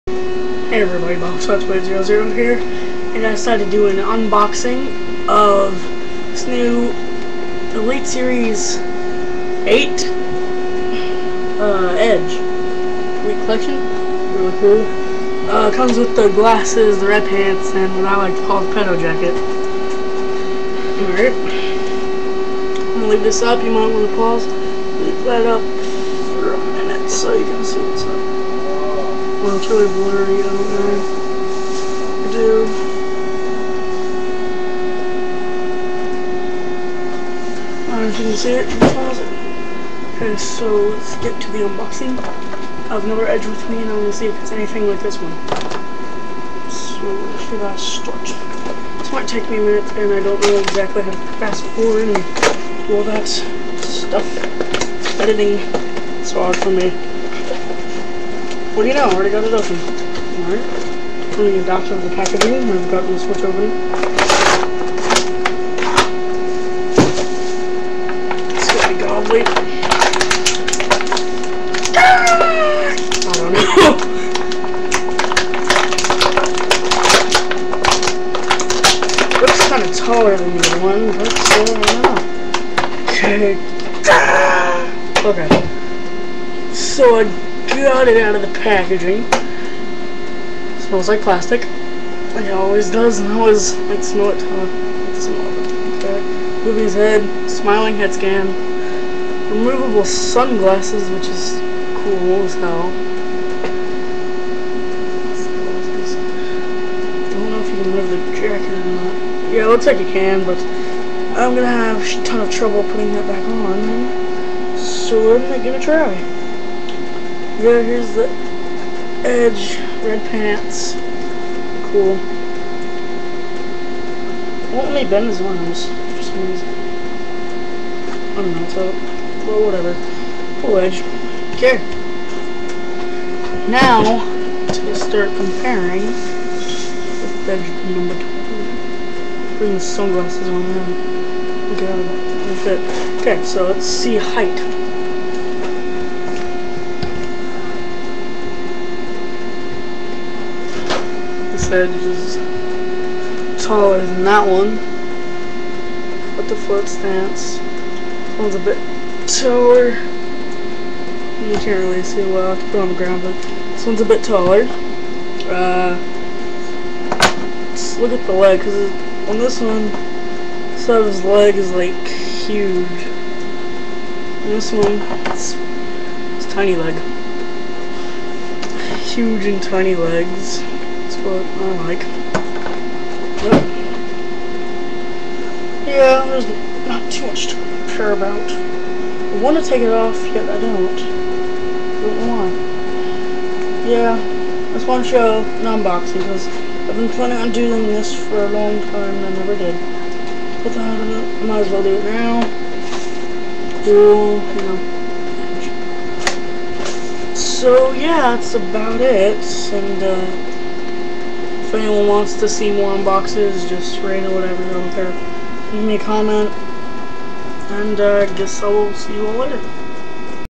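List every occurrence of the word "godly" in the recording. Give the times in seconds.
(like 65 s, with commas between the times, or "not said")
69 s.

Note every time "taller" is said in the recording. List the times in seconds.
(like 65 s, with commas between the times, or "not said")
79 s, 153 s, 159 s, 164 s.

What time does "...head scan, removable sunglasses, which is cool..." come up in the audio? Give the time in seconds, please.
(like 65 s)
97 s.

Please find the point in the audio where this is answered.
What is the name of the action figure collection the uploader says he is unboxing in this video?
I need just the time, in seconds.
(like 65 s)
11 s.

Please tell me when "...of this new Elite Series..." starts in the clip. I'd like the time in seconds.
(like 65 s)
5 s.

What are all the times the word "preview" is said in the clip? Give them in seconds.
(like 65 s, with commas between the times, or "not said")
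not said.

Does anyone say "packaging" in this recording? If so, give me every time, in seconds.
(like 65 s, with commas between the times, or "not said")
62 s, 88 s.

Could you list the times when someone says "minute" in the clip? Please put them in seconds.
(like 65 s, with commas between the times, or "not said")
26 s, 49 s.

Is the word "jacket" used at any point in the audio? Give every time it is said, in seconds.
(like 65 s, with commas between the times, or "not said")
18 s, 108 s.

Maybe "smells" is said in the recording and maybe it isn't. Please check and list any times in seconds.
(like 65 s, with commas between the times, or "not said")
90 s, 95 s.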